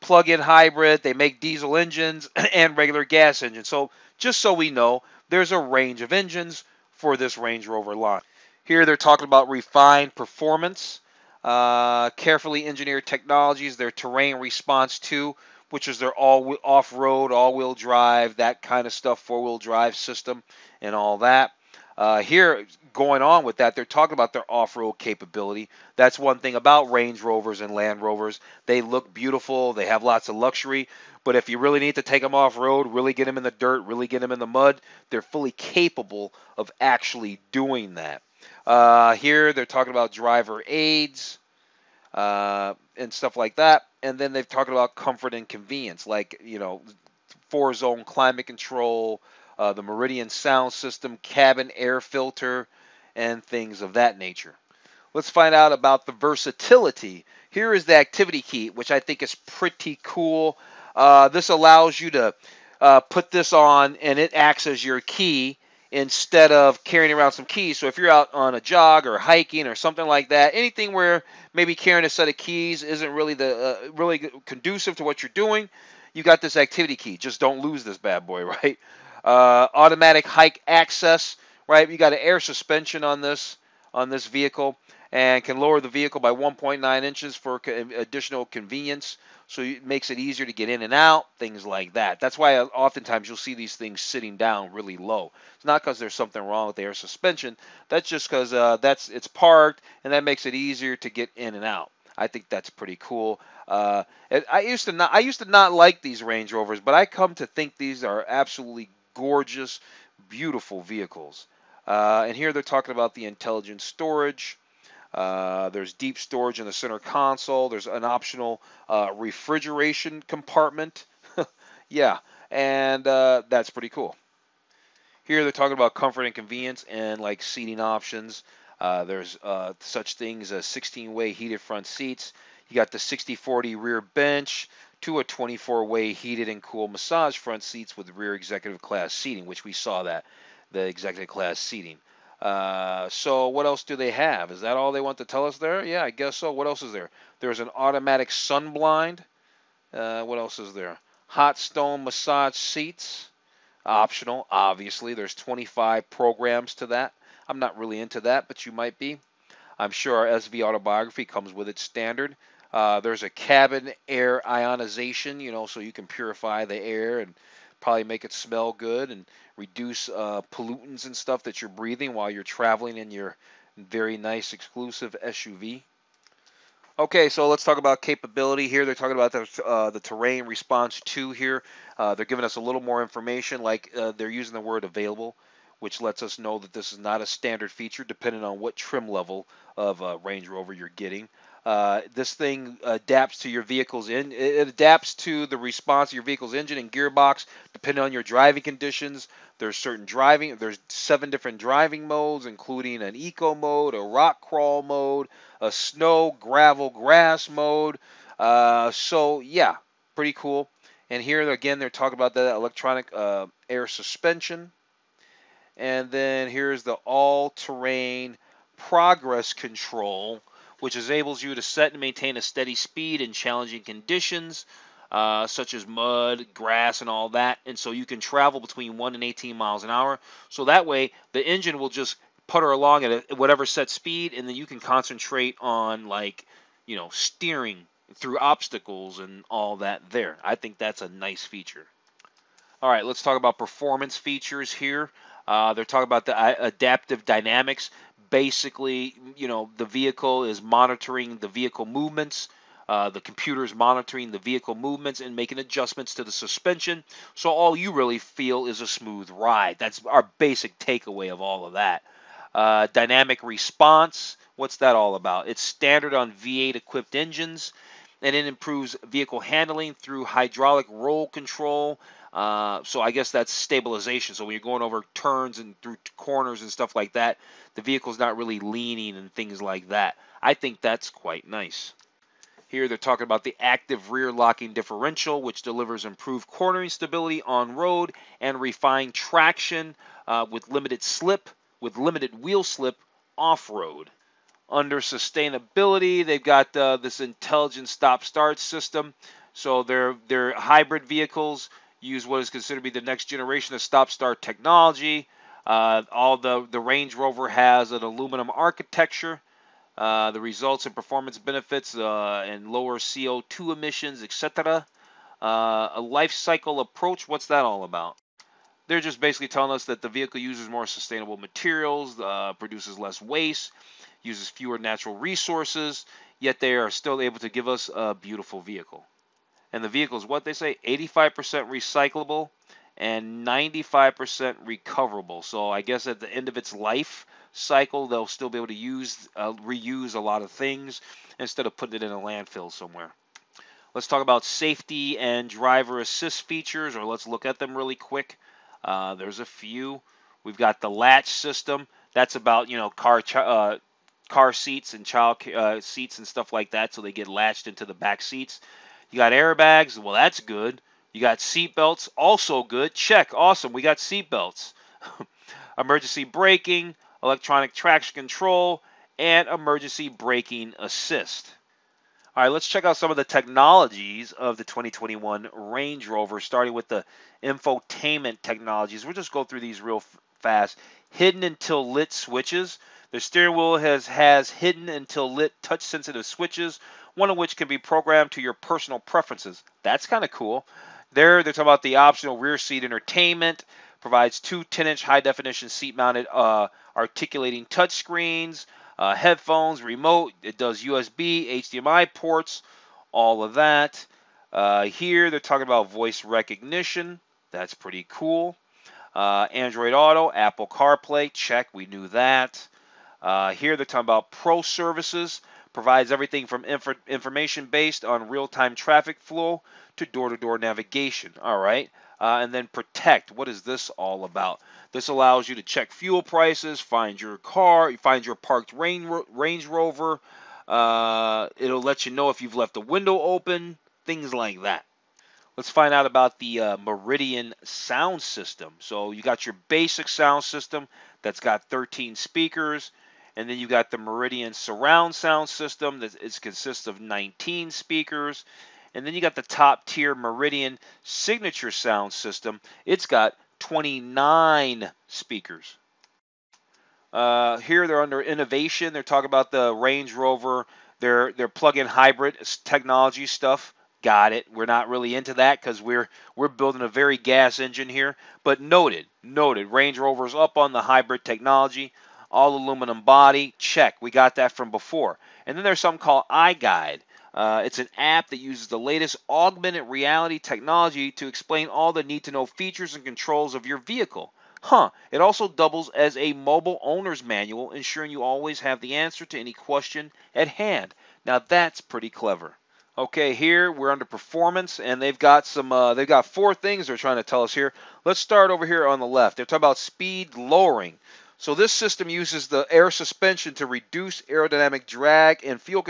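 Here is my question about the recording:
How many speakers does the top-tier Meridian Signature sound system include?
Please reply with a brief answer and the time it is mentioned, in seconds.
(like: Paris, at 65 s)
29, at 453 s.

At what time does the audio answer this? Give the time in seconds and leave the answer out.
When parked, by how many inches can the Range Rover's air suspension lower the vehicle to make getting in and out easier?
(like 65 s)
86 s.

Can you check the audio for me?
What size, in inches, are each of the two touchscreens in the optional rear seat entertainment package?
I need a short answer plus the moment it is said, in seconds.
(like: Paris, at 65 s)
10 inch, at 394 s.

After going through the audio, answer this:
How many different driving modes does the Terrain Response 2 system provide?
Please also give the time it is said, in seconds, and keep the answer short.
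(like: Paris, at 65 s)
seven, at 200 s.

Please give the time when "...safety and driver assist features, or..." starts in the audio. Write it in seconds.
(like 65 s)
344 s.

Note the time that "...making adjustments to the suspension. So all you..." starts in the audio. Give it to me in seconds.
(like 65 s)
255 s.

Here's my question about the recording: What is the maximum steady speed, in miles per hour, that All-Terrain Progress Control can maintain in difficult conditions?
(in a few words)
18.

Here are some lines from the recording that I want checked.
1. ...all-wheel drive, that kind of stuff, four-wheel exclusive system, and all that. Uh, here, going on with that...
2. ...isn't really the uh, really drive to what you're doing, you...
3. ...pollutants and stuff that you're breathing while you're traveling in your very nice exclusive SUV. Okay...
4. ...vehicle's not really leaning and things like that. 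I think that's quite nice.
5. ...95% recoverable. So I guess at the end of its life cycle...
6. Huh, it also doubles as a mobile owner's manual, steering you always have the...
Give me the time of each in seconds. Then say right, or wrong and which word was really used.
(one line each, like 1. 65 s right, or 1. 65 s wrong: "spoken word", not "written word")
1. 17 s wrong: "drive", not "exclusive"
2. 72 s wrong: "conducive", not "drive"
3. 170 s right
4. 277 s right
5. 333 s right
6. 484 s wrong: "ensuring", not "steering".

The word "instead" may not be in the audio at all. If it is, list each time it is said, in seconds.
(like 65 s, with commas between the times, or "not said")
65 s, 341 s.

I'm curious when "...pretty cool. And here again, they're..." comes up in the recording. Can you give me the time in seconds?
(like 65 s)
210 s.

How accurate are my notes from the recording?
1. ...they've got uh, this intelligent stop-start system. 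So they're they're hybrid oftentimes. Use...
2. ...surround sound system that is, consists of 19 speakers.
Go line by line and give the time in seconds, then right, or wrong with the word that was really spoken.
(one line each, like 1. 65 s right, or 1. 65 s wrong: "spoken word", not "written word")
1. 296 s wrong: "vehicles", not "oftentimes"
2. 444 s right.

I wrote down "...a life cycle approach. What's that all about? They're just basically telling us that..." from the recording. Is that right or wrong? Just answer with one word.
right.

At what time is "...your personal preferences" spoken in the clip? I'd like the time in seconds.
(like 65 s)
388 s.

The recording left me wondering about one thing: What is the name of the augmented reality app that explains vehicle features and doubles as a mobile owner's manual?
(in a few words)
iGuide.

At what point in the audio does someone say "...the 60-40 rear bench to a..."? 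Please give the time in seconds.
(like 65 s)
132 s.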